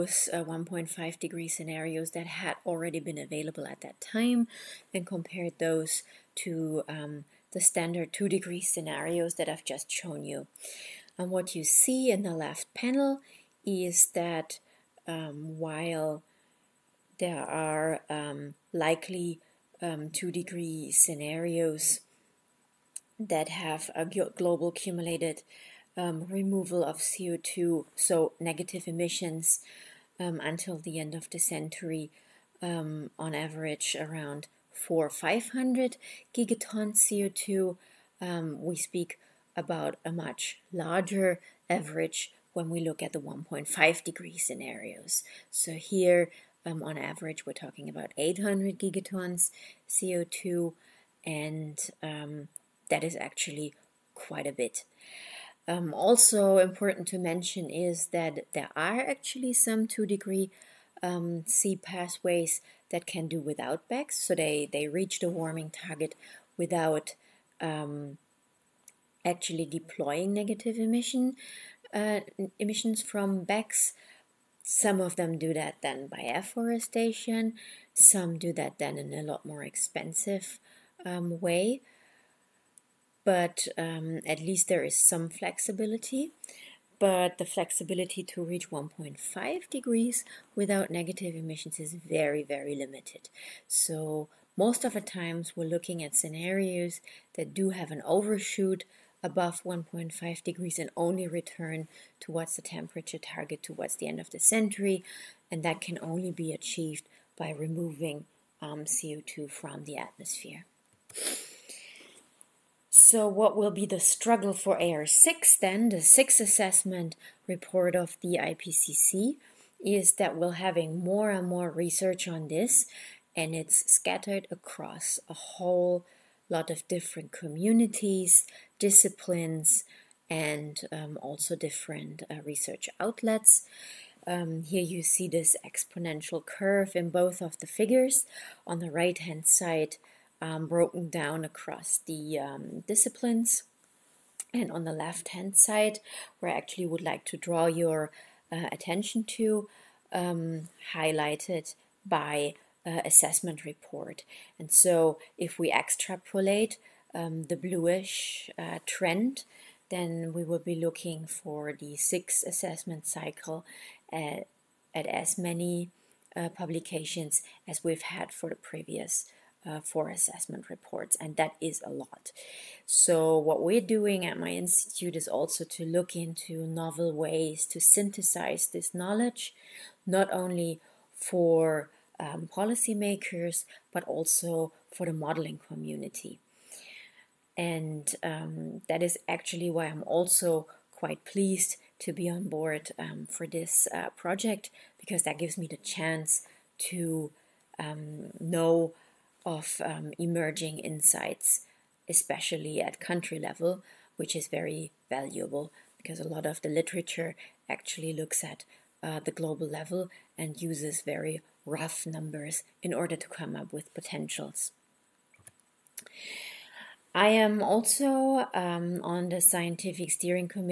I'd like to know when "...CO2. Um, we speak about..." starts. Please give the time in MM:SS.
00:36.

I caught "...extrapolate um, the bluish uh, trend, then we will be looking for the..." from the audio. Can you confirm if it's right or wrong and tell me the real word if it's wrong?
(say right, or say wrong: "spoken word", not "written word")
right.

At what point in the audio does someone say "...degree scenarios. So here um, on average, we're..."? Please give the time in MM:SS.
00:44.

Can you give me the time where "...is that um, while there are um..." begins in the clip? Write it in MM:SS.
00:13.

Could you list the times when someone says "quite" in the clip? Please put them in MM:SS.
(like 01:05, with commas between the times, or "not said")
00:54, 03:10.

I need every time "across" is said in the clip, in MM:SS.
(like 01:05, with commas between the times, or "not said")
02:04, 02:21.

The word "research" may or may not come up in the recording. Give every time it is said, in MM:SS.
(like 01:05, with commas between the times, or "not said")
02:01, 02:12.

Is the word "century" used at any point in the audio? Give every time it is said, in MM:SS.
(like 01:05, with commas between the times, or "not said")
00:31, 01:44.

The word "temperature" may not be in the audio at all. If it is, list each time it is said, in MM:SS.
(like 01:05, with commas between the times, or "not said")
01:42.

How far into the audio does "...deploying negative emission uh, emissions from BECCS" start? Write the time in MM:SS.
01:09.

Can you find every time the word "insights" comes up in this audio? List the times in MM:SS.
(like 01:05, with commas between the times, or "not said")
03:20.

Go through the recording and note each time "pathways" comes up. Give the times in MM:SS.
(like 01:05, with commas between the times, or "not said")
01:01.